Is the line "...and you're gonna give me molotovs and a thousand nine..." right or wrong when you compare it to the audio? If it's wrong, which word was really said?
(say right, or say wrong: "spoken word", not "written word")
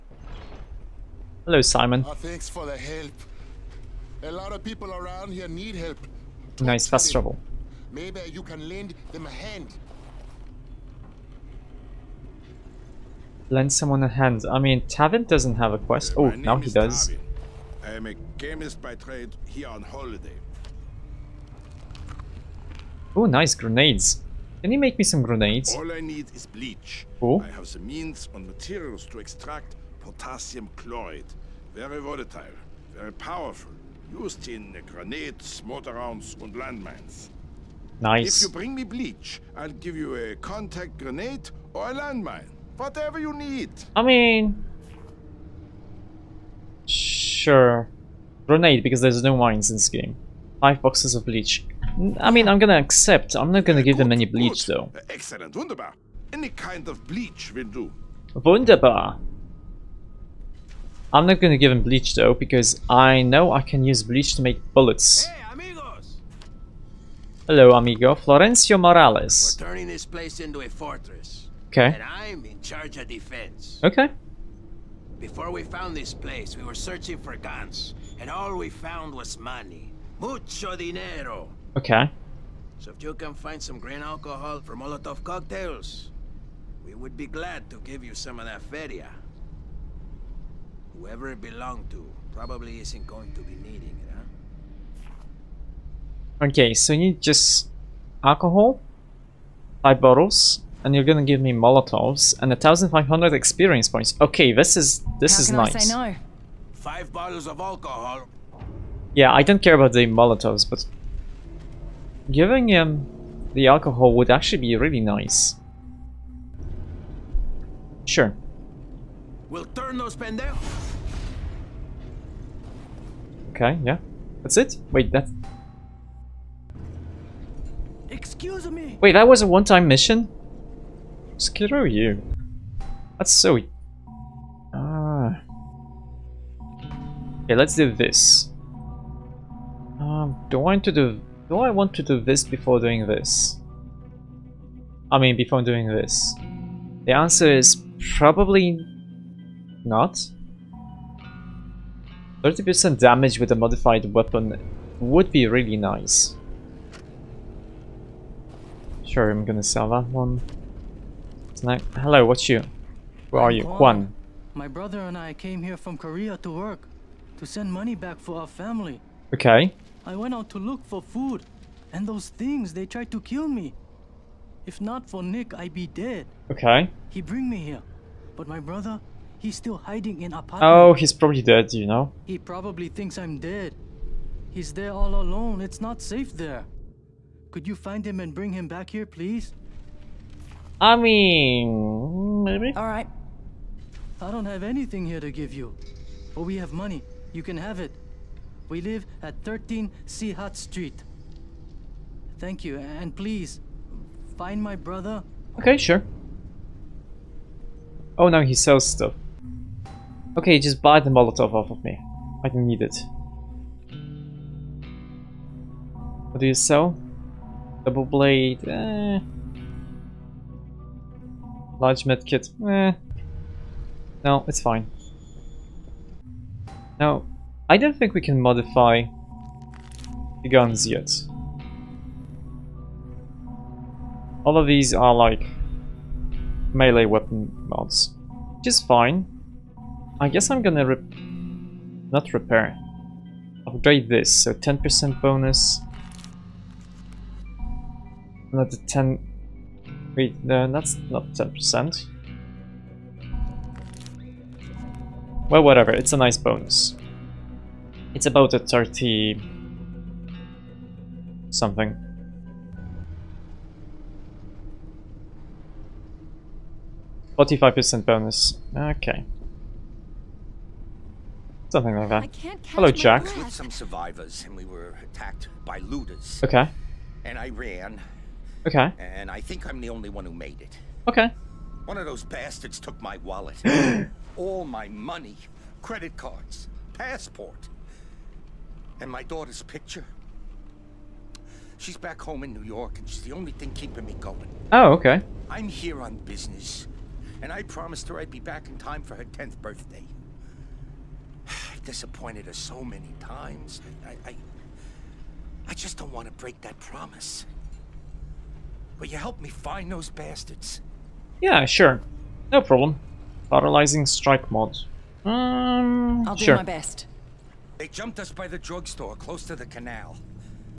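wrong: "five", not "nine".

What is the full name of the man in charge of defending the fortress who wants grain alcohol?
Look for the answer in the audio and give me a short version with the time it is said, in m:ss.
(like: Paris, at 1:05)
Florencio Morales, at 1:08.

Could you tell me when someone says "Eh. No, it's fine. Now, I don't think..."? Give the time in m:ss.
3:42.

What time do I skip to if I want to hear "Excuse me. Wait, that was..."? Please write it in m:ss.
2:08.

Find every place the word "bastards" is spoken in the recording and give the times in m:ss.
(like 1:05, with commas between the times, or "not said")
4:42, 5:10.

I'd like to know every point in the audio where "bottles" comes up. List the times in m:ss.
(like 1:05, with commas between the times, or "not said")
1:40, 1:47.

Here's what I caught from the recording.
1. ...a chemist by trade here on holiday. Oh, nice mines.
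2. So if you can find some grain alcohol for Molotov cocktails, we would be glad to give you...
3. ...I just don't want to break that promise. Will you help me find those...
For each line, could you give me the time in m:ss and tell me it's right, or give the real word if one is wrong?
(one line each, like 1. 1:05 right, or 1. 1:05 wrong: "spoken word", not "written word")
1. 0:18 wrong: "grenades", not "mines"
2. 1:22 right
3. 5:05 right.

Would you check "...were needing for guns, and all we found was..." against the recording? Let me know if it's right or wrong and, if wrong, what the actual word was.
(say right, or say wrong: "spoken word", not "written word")
wrong: "searching", not "needing".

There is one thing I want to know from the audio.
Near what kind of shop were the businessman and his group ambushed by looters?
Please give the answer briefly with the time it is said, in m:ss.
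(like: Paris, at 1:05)
Drugstore, at 5:18.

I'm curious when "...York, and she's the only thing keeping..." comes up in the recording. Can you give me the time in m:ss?
4:52.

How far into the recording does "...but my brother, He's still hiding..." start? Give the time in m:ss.
2:58.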